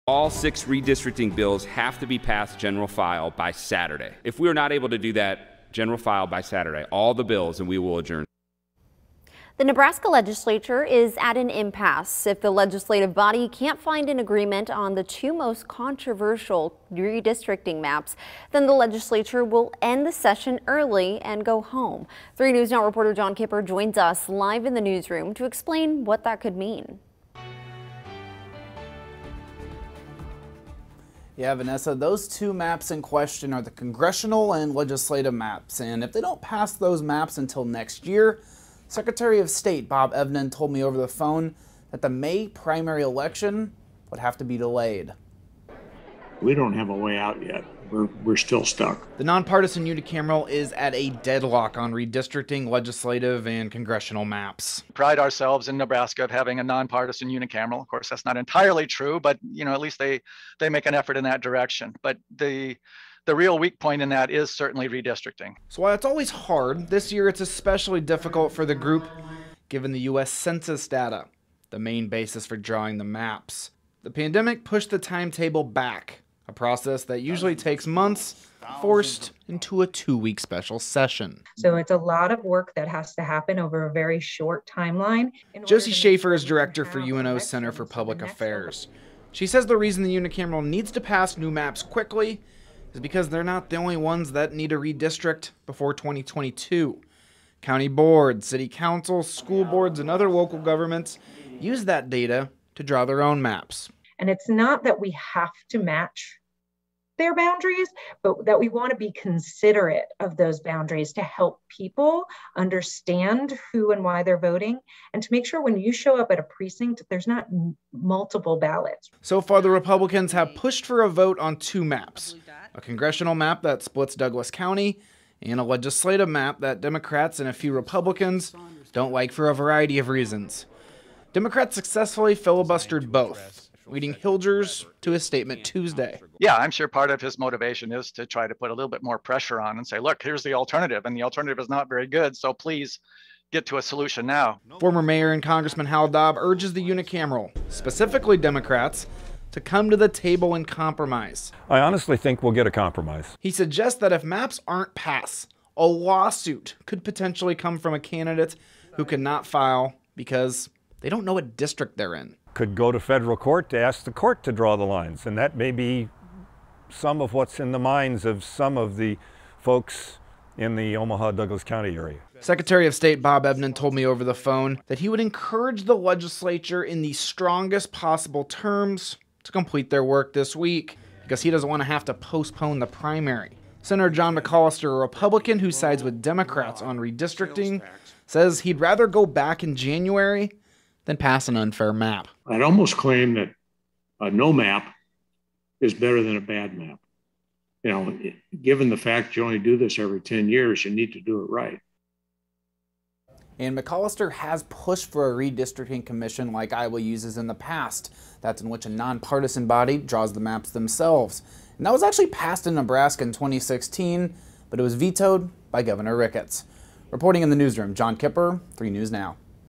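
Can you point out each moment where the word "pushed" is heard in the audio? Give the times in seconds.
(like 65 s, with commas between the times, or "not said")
74 s, 120 s, 204 s.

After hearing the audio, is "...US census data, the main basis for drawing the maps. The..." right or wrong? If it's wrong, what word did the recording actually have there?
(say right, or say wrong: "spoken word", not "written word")
right.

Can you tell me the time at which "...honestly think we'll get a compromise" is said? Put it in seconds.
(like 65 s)
151 s.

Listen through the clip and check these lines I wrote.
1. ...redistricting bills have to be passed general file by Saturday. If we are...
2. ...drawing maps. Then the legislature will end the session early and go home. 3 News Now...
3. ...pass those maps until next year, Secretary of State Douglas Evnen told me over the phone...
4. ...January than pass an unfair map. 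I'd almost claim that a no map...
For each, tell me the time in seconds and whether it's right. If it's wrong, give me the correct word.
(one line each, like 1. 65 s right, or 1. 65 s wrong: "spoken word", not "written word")
1. 0 s right
2. 16 s wrong: "redistricting", not "drawing"
3. 36 s wrong: "Bob", not "Douglas"
4. 189 s right.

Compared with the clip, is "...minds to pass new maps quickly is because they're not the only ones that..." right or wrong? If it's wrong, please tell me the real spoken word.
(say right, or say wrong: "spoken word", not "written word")
wrong: "needs", not "minds".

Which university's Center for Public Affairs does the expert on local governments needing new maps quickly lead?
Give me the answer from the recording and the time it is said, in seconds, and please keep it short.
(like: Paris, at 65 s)
UNO, at 86 s.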